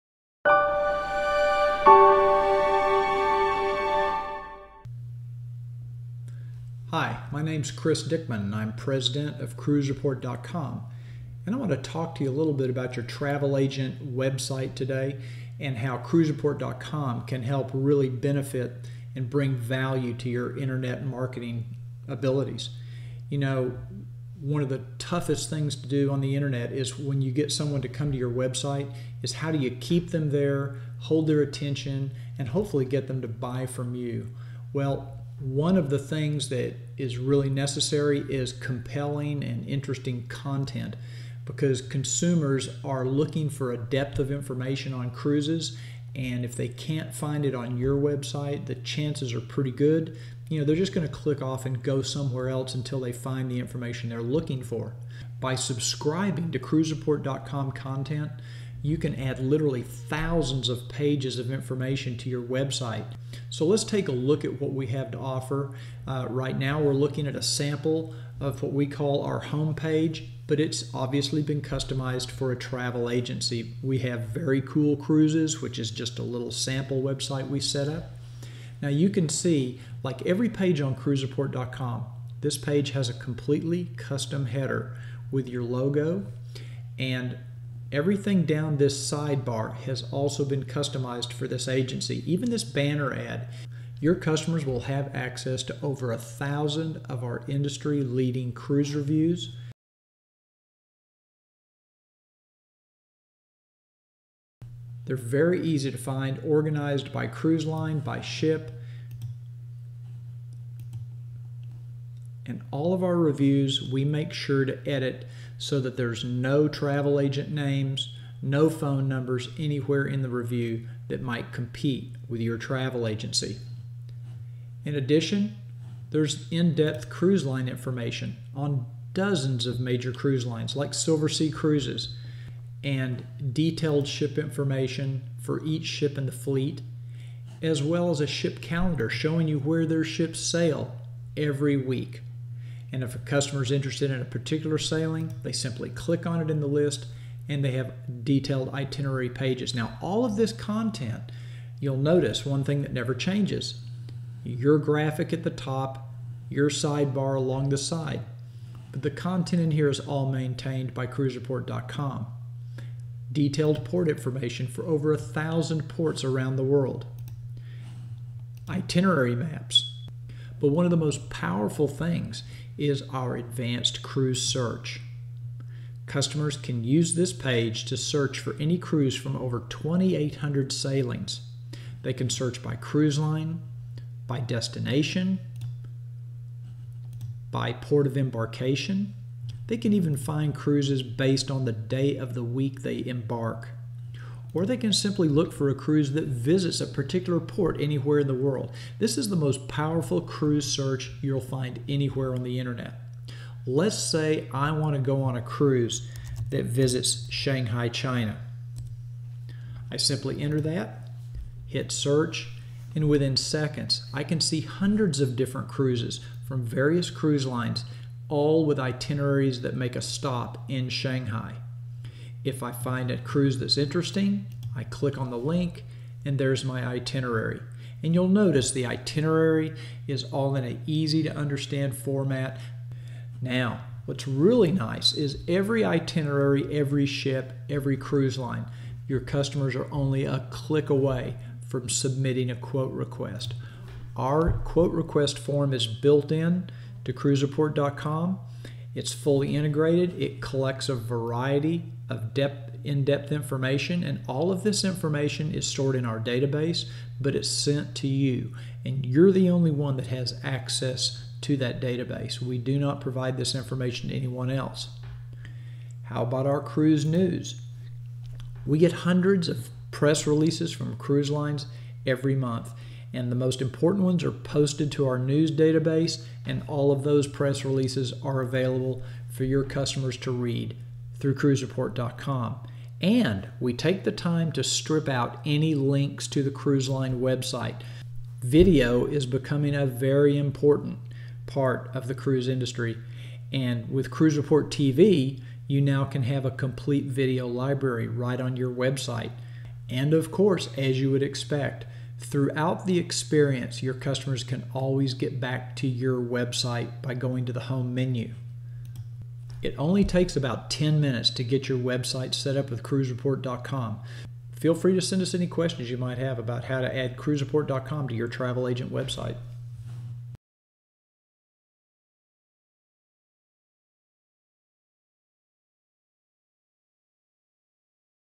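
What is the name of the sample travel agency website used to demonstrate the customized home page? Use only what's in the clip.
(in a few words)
Very Cool Cruises.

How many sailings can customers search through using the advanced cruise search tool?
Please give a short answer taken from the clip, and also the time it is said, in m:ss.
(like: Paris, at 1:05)
over 2,800, at 2:59.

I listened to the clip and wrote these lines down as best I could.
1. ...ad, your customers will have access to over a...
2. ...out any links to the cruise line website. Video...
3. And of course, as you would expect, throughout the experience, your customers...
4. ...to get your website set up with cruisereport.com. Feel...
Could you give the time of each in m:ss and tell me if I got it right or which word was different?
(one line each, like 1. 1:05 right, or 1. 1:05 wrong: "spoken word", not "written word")
1. 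1:33 right
2. 4:45 right
3. 4:59 right
4. 5:11 right.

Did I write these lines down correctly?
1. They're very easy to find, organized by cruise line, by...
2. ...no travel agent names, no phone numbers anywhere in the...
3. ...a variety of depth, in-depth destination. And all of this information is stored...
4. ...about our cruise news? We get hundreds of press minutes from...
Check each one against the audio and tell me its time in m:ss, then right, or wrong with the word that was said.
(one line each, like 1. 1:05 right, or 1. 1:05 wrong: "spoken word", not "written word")
1. 1:45 right
2. 1:56 right
3. 4:10 wrong: "information", not "destination"
4. 4:26 wrong: "releases", not "minutes".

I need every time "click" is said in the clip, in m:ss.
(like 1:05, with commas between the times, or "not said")
0:51, 2:25, 3:44, 4:00.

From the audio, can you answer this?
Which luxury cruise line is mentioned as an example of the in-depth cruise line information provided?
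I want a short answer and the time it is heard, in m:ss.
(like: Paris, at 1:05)
Silversea Cruises, at 2:10.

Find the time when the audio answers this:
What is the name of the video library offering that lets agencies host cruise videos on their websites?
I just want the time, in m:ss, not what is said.
4:54.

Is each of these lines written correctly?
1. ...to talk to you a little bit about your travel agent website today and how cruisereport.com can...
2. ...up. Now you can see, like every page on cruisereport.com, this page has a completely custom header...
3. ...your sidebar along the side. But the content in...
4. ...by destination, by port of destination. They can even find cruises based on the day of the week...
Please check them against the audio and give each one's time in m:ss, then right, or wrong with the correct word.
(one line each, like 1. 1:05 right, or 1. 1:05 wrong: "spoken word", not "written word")
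1. 0:11 right
2. 1:17 right
3. 2:36 right
4. 3:04 wrong: "embarkation", not "destination".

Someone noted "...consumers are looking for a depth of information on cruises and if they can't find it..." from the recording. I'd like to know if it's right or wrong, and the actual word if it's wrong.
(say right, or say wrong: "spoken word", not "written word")
right.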